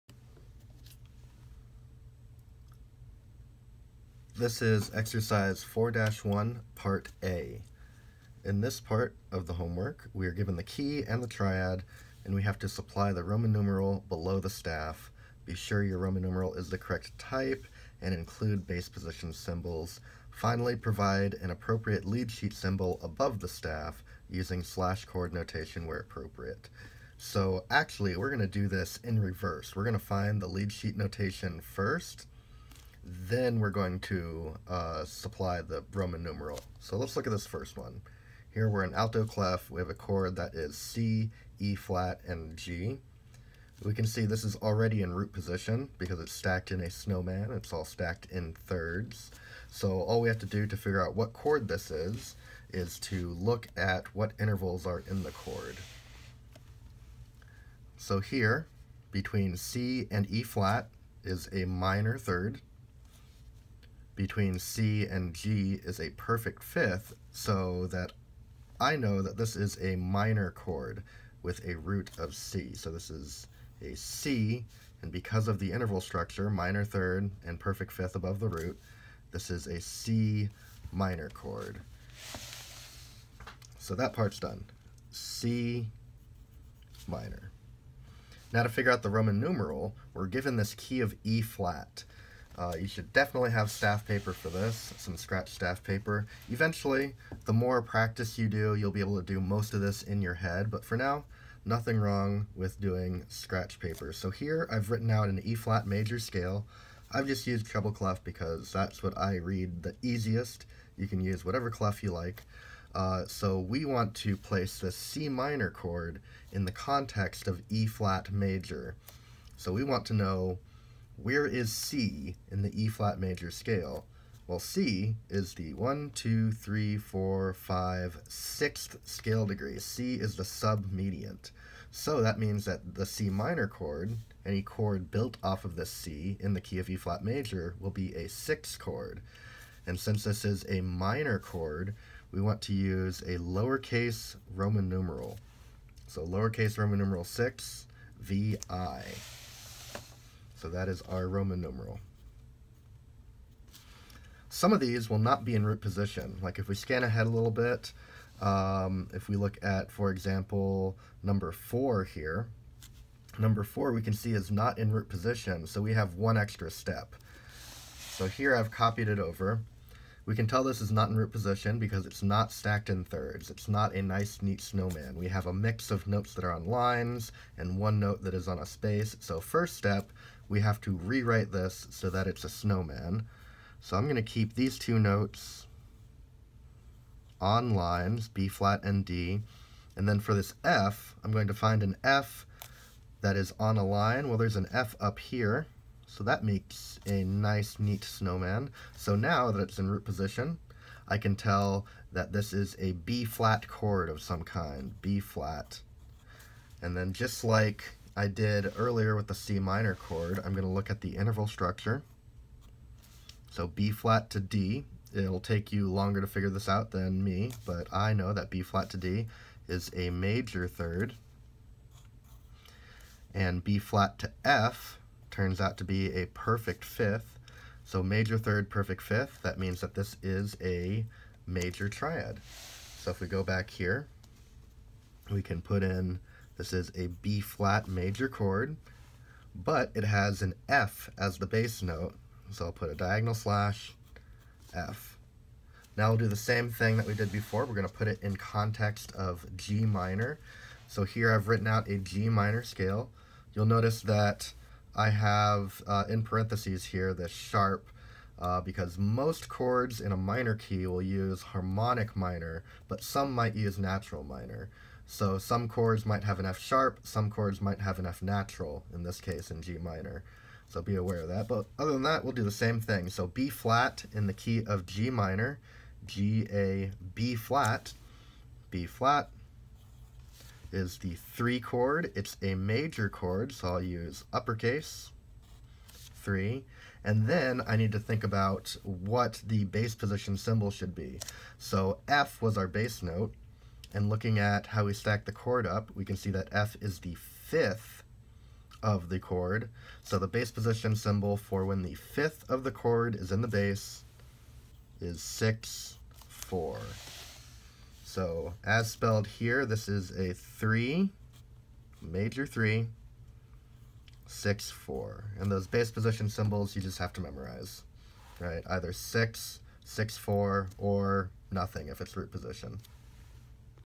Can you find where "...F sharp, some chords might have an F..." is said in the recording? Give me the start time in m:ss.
4:26.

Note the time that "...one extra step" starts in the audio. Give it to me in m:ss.
2:46.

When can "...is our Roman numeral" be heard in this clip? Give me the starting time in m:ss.
2:30.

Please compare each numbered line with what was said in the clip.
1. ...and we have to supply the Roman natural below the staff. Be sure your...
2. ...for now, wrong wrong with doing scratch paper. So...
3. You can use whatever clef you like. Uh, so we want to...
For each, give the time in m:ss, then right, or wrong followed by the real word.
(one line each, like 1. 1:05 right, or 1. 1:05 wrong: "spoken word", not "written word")
1. 0:12 wrong: "numeral", not "natural"
2. 1:40 wrong: "nothing", not "wrong"
3. 1:50 right.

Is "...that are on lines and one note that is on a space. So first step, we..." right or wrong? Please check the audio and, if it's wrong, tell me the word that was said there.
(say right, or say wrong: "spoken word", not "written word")
right.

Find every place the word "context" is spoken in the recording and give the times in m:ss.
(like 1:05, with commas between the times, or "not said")
1:56, 4:08.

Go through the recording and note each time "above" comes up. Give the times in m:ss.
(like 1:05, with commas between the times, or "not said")
0:23, 1:18.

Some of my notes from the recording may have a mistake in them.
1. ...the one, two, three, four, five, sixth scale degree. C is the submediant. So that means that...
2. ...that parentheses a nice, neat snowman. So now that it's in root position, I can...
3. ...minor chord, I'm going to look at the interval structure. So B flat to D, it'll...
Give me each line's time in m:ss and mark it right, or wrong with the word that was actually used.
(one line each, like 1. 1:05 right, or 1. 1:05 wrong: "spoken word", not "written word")
1. 2:05 right
2. 3:16 wrong: "makes", not "parentheses"
3. 3:29 right.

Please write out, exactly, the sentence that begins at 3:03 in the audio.
So I'm going to keep these two notes on lines, B flat and D.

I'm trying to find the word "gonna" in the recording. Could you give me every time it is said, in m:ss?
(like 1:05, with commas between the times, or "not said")
4:07.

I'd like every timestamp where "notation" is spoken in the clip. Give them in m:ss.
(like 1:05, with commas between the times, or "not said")
0:25, 0:30.